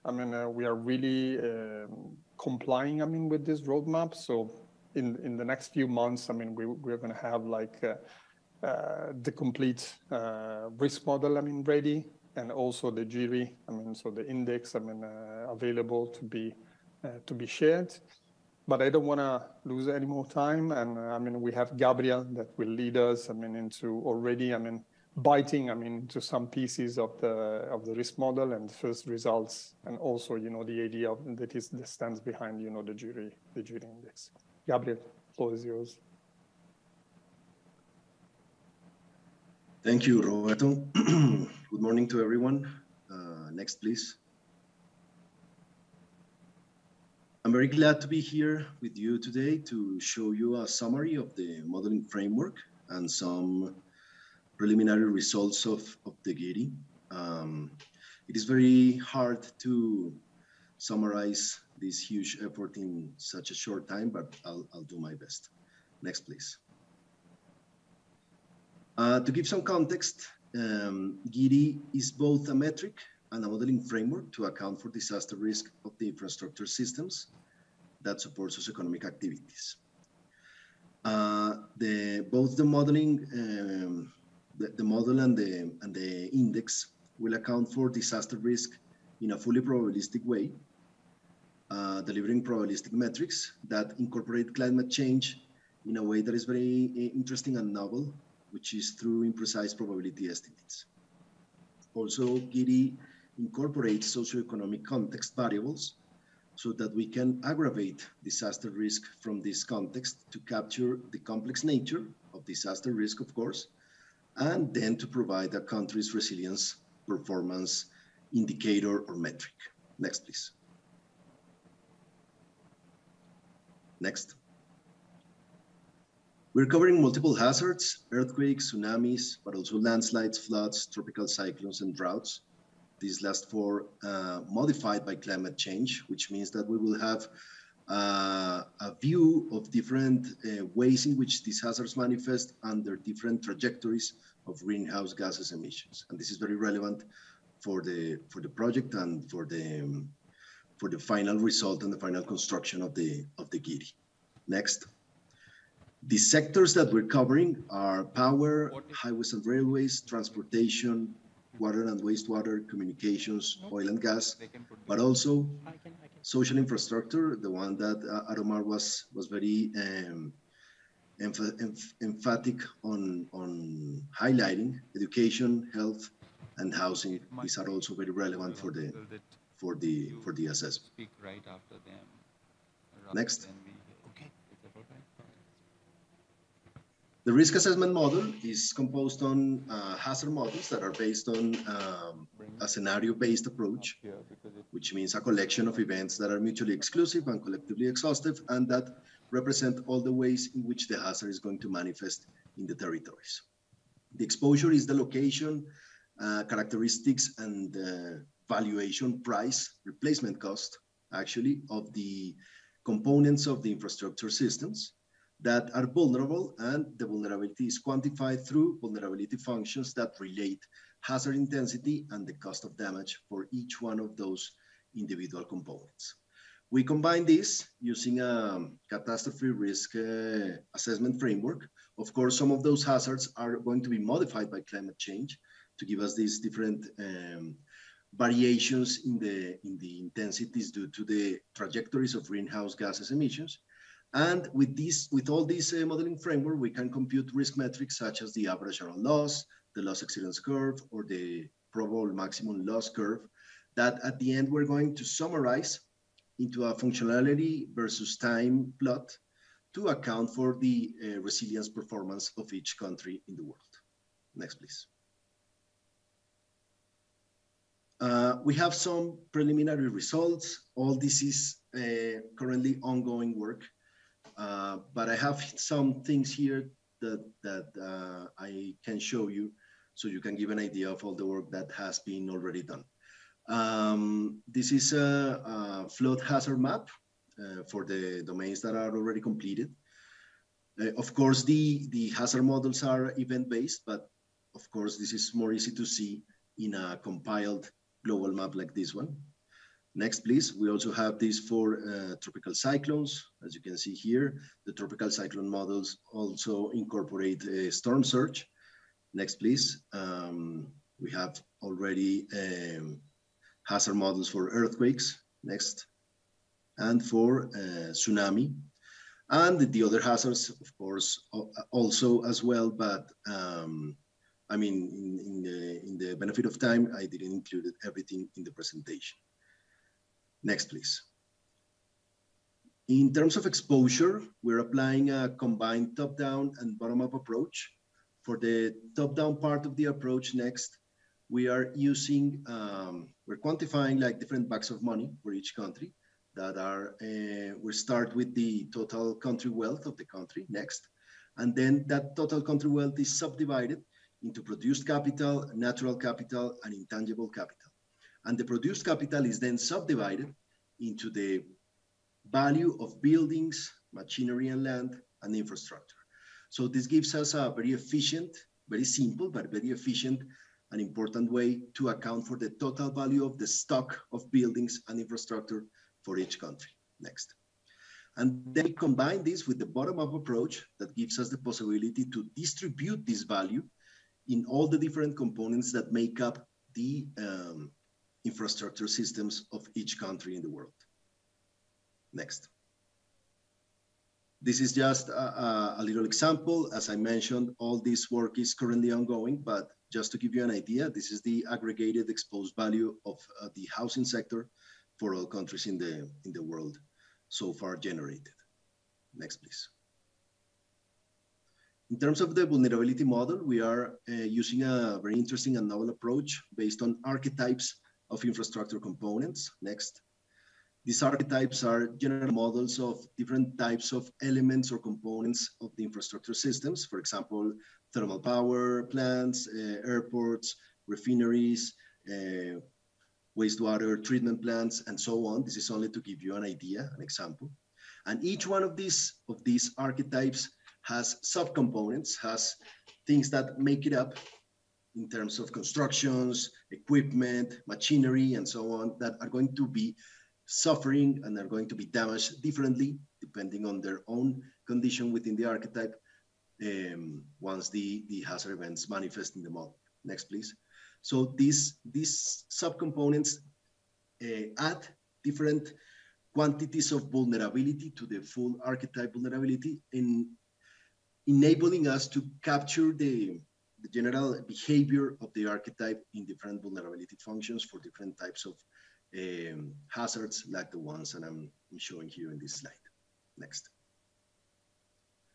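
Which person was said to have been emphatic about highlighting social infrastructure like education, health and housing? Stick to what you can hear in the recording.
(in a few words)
Aromar.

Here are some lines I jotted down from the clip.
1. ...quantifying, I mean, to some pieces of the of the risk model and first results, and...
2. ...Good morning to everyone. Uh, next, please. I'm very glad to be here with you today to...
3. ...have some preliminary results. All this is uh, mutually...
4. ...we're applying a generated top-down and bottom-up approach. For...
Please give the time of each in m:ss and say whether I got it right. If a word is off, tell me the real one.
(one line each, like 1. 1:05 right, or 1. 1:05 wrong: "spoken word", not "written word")
1. 0:25 wrong: "biting", not "quantifying"
2. 0:41 right
3. 4:28 wrong: "currently", not "mutually"
4. 5:34 wrong: "combined", not "generated".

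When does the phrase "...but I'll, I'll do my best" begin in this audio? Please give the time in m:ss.
1:04.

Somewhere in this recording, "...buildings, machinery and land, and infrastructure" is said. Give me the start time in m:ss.
6:03.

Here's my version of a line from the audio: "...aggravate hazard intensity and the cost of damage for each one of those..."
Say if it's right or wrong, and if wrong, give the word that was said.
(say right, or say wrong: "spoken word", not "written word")
wrong: "relate", not "aggravate".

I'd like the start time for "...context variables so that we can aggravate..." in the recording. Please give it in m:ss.
1:44.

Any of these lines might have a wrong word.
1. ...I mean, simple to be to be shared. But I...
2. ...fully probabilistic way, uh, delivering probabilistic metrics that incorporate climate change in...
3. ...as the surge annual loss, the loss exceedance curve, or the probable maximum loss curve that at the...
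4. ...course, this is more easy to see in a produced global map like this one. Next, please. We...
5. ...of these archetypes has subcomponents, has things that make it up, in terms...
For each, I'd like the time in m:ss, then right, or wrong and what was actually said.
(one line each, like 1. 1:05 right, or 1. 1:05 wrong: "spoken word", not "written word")
1. 0:14 wrong: "available", not "simple"
2. 1:29 right
3. 4:08 wrong: "average", not "surge"
4. 4:54 wrong: "compiled", not "produced"
5. 7:19 right.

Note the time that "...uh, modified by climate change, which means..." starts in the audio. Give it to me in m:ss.
2:14.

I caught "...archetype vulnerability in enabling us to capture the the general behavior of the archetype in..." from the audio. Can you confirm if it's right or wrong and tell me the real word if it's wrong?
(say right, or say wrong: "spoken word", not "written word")
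right.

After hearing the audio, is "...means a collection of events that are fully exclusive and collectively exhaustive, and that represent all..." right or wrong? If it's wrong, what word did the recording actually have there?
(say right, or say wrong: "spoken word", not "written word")
wrong: "mutually", not "fully".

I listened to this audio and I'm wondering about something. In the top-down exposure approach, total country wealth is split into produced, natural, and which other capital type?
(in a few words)
intangible capital.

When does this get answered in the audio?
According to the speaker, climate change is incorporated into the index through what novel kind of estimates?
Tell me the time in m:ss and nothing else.
1:39.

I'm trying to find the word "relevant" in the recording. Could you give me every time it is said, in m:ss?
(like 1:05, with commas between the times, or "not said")
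2:26, 2:58.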